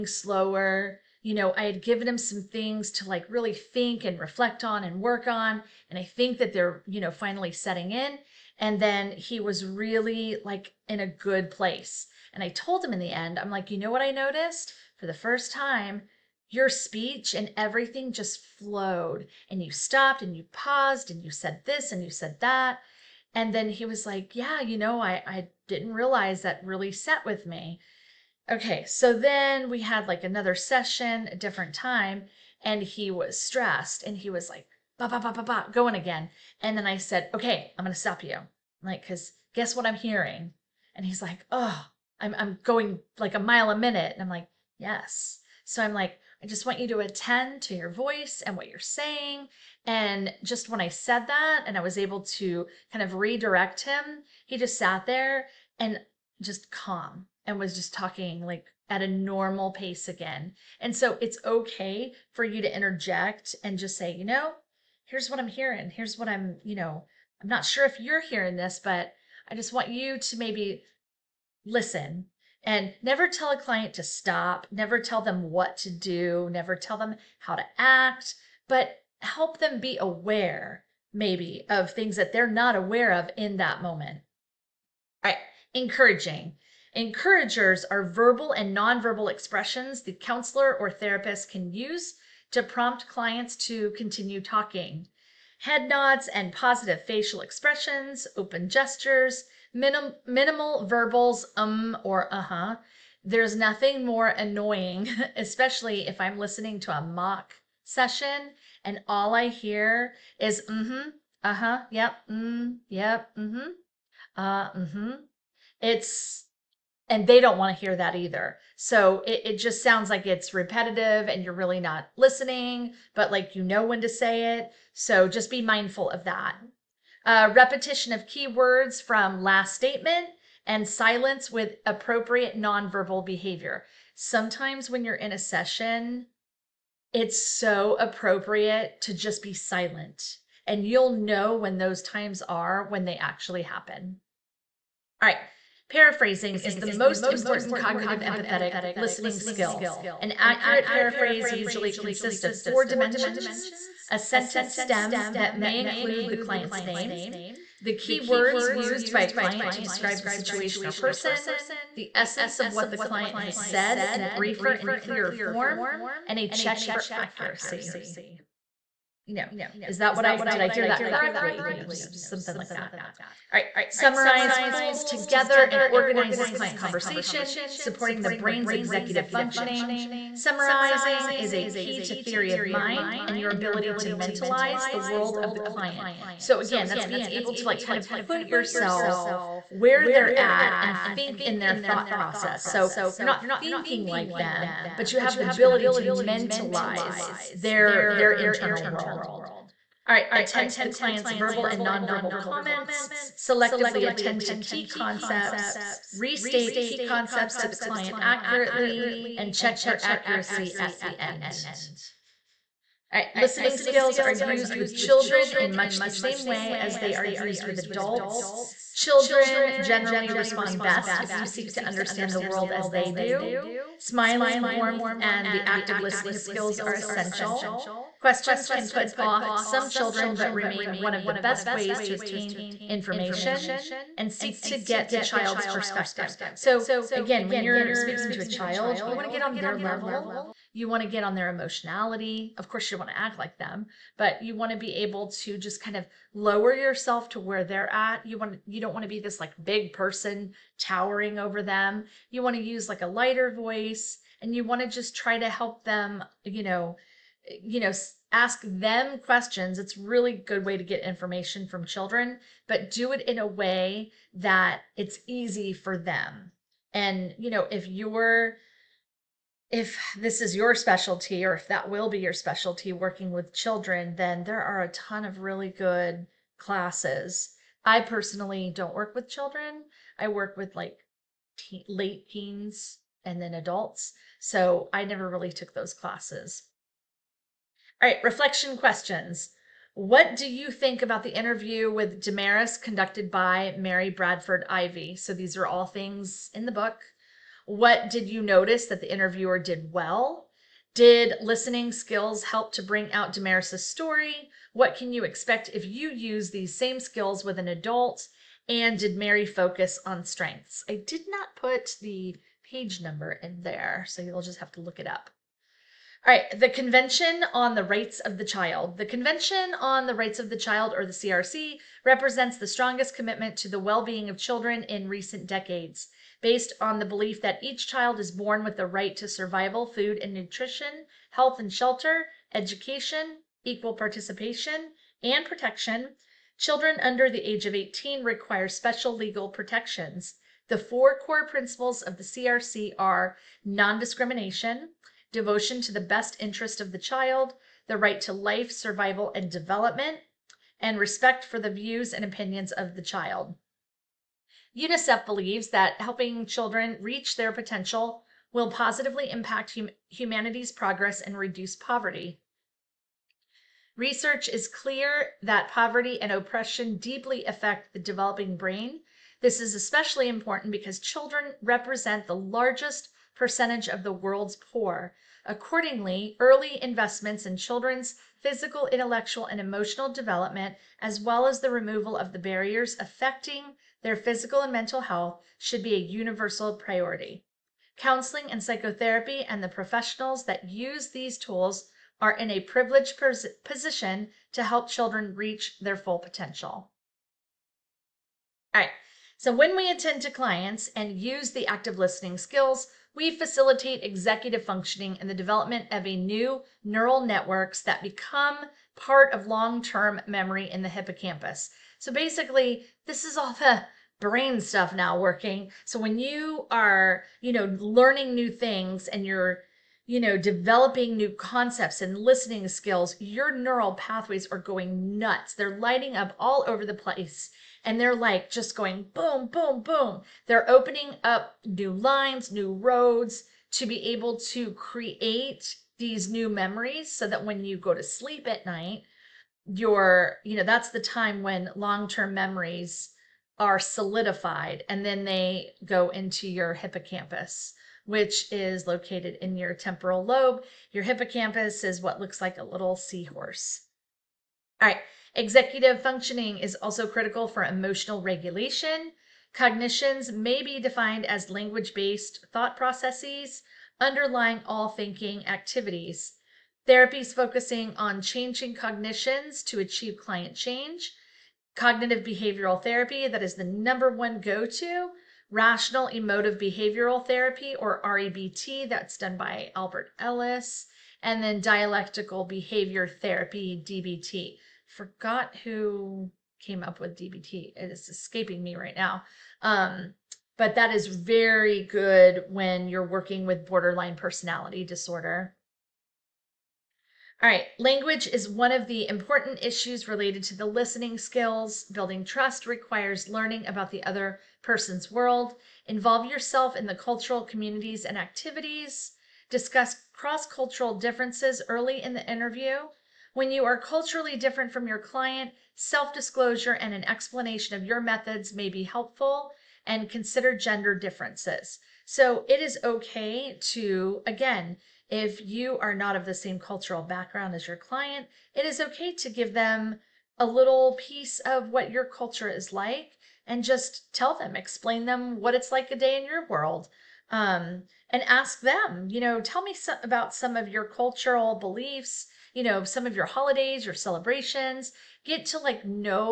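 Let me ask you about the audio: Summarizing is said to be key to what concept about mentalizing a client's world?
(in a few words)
Theory of mind.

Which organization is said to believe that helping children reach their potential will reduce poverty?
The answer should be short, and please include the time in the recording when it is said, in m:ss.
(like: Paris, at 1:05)
UNICEF, at 5:54.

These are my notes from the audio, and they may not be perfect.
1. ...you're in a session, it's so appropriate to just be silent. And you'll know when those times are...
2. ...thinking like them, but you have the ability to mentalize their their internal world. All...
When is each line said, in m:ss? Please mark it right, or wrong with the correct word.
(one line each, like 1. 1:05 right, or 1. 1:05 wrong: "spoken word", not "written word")
1. 2:15 right
2. 3:13 right.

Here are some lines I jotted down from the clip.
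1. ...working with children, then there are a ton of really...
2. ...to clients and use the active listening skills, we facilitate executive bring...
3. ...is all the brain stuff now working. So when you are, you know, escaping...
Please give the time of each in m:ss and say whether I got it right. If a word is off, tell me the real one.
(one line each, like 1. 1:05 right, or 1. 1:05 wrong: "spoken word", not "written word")
1. 4:32 right
2. 6:40 wrong: "functioning", not "bring"
3. 6:53 wrong: "learning", not "escaping".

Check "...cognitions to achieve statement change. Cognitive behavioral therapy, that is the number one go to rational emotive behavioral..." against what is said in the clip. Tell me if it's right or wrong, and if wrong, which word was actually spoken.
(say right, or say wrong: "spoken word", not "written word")
wrong: "client", not "statement".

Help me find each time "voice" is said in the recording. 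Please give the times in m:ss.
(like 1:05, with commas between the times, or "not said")
0:47, 4:13.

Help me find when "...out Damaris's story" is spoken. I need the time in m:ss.
5:03.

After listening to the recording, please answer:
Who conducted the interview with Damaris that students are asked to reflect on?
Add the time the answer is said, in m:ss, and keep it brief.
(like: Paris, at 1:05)
Mary Bradford Ivey, at 4:53.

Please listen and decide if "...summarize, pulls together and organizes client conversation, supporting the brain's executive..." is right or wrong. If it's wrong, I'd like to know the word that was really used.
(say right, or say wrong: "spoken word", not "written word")
right.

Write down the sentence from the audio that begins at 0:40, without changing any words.
And he's like, oh, I'm I'm going like a mile a minute.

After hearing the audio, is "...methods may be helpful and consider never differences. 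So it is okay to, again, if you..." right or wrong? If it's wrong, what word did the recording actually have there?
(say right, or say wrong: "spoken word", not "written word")
wrong: "gender", not "never".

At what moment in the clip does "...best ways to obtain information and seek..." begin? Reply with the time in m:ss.
3:51.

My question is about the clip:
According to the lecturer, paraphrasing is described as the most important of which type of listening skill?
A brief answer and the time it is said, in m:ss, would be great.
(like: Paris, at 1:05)
Cognitive empathetic listening skill, at 2:27.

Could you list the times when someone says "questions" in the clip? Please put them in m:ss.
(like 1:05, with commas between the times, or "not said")
3:48, 4:19, 4:48.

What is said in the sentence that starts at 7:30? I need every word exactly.
Your hippocampus is what looks like a little seahorse.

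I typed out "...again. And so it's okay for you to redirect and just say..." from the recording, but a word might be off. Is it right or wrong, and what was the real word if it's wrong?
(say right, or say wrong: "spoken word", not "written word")
wrong: "interject", not "redirect".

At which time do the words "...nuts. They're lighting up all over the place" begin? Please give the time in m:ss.
7:05.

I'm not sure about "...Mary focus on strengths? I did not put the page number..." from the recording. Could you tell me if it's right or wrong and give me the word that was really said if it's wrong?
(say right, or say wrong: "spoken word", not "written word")
right.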